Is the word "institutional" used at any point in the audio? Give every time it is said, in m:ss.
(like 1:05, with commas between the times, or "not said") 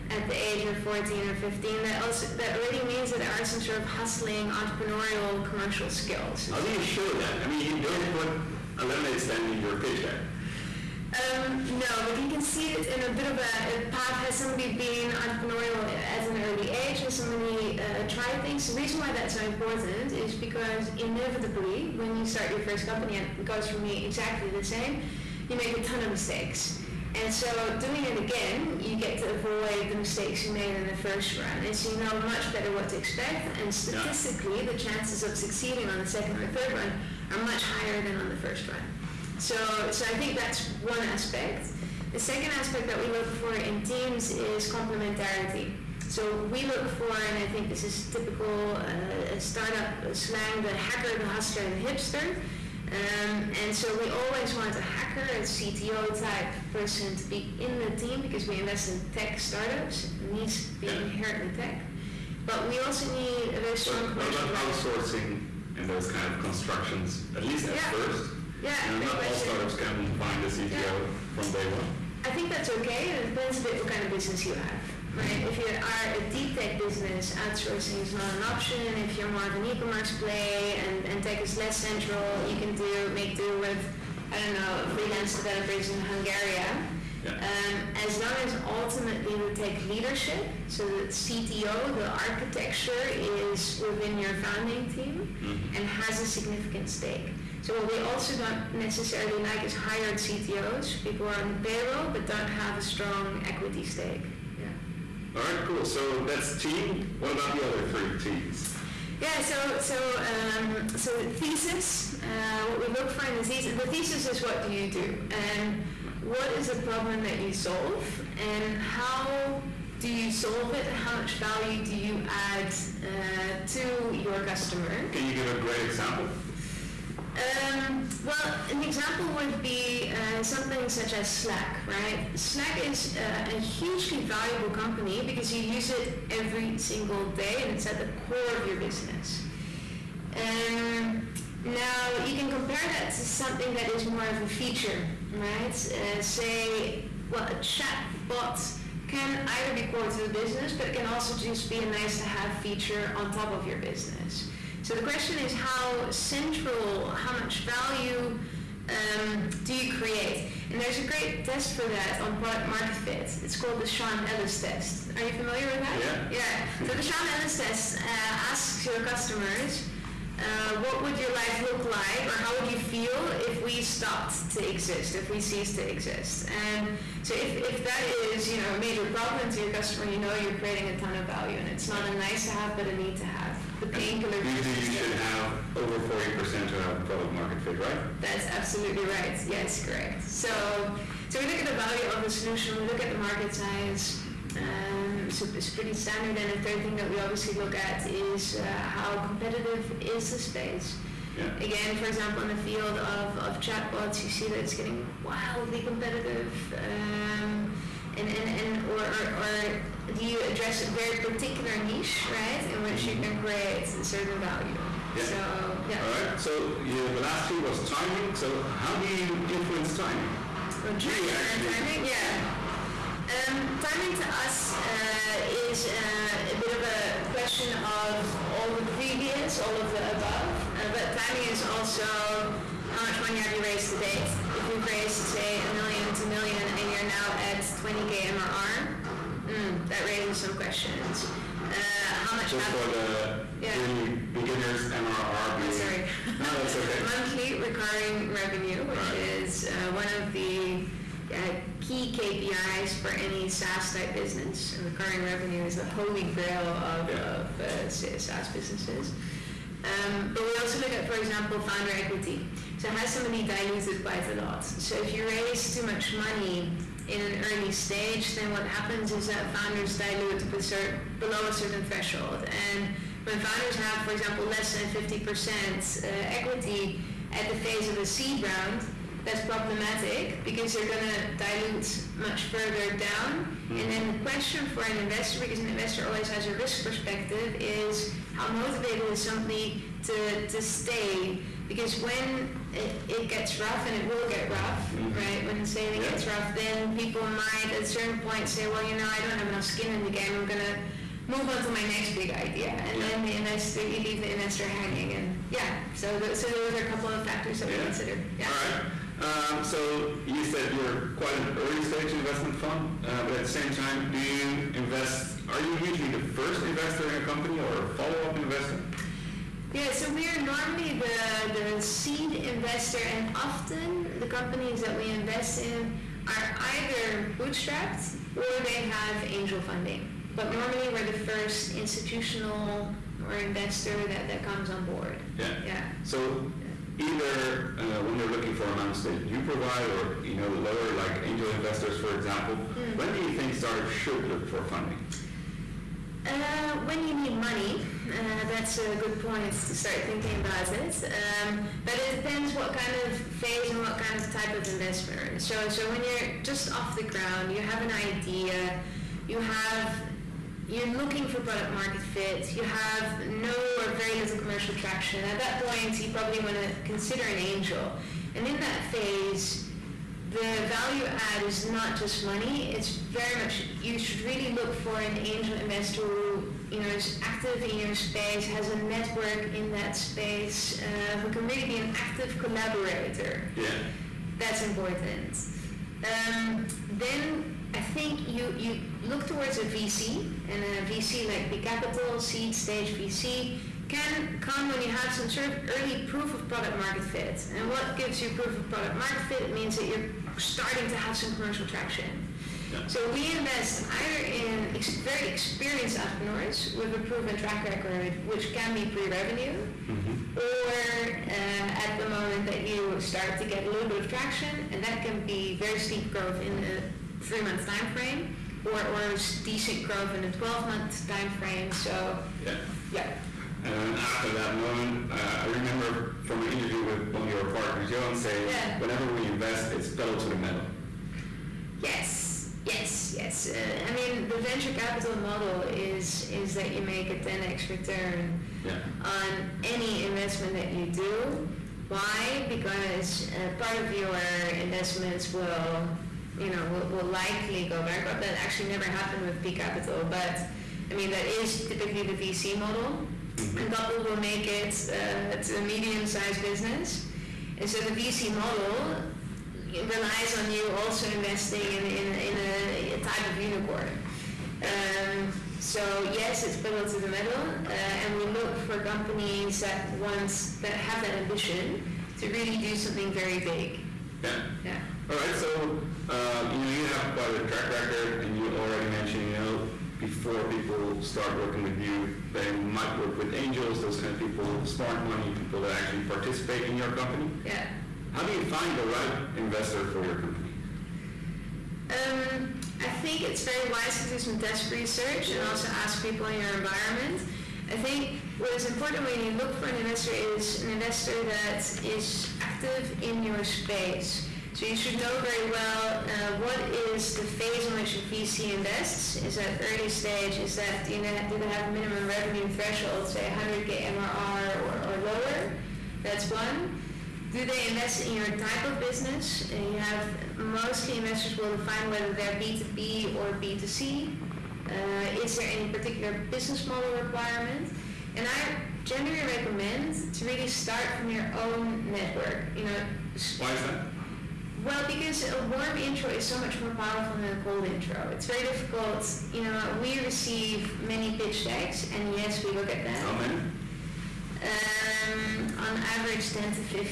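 5:31.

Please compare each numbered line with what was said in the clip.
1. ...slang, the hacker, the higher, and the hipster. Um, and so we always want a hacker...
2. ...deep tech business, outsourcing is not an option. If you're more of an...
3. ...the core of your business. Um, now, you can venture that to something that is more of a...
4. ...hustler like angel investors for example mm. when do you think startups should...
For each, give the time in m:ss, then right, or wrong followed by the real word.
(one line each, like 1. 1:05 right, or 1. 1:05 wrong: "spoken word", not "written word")
1. 0:50 wrong: "hustler", not "higher"
2. 1:16 right
3. 2:17 wrong: "compare", not "venture"
4. 5:40 wrong: "lower", not "hustler".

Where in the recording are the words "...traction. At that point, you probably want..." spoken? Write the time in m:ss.
6:04.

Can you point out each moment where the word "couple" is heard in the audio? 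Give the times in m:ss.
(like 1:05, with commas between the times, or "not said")
5:06, 7:33.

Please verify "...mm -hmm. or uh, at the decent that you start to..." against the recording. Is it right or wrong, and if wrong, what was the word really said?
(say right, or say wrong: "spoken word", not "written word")
wrong: "moment", not "decent".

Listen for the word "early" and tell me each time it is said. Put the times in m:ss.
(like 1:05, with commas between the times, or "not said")
0:16, 4:27, 5:11, 6:35, 8:29.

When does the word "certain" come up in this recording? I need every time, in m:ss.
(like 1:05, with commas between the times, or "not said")
3:34, 4:31, 4:57.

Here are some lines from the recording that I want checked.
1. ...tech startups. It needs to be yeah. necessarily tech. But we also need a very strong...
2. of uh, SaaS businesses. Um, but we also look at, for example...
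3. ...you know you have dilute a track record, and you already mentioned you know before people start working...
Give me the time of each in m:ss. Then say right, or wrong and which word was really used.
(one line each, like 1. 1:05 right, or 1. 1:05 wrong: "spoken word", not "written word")
1. 0:59 wrong: "inherently", not "necessarily"
2. 4:17 right
3. 7:56 wrong: "quite", not "dilute".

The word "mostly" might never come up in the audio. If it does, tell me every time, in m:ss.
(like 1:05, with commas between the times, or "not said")
8:40.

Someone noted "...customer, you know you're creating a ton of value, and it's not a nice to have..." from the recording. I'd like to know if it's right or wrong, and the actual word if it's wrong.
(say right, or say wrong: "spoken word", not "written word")
right.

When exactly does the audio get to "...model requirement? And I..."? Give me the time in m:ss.
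8:46.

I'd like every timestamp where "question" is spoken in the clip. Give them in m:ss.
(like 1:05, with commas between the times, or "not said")
1:09, 2:35, 3:47, 4:00, 4:44.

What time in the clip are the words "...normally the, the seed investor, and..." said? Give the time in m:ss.
5:20.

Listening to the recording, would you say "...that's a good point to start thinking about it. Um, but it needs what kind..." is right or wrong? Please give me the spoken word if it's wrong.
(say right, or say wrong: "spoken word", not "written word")
wrong: "depends", not "needs".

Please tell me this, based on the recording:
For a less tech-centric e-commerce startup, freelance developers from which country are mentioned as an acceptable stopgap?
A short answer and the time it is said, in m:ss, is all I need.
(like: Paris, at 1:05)
Hungary, at 1:25.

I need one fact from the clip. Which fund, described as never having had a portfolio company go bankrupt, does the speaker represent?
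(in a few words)
Peak Capital.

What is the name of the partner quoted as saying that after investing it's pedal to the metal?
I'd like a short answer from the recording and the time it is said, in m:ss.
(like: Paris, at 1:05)
Johan, at 7:07.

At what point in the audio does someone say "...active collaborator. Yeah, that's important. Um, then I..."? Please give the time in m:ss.
6:21.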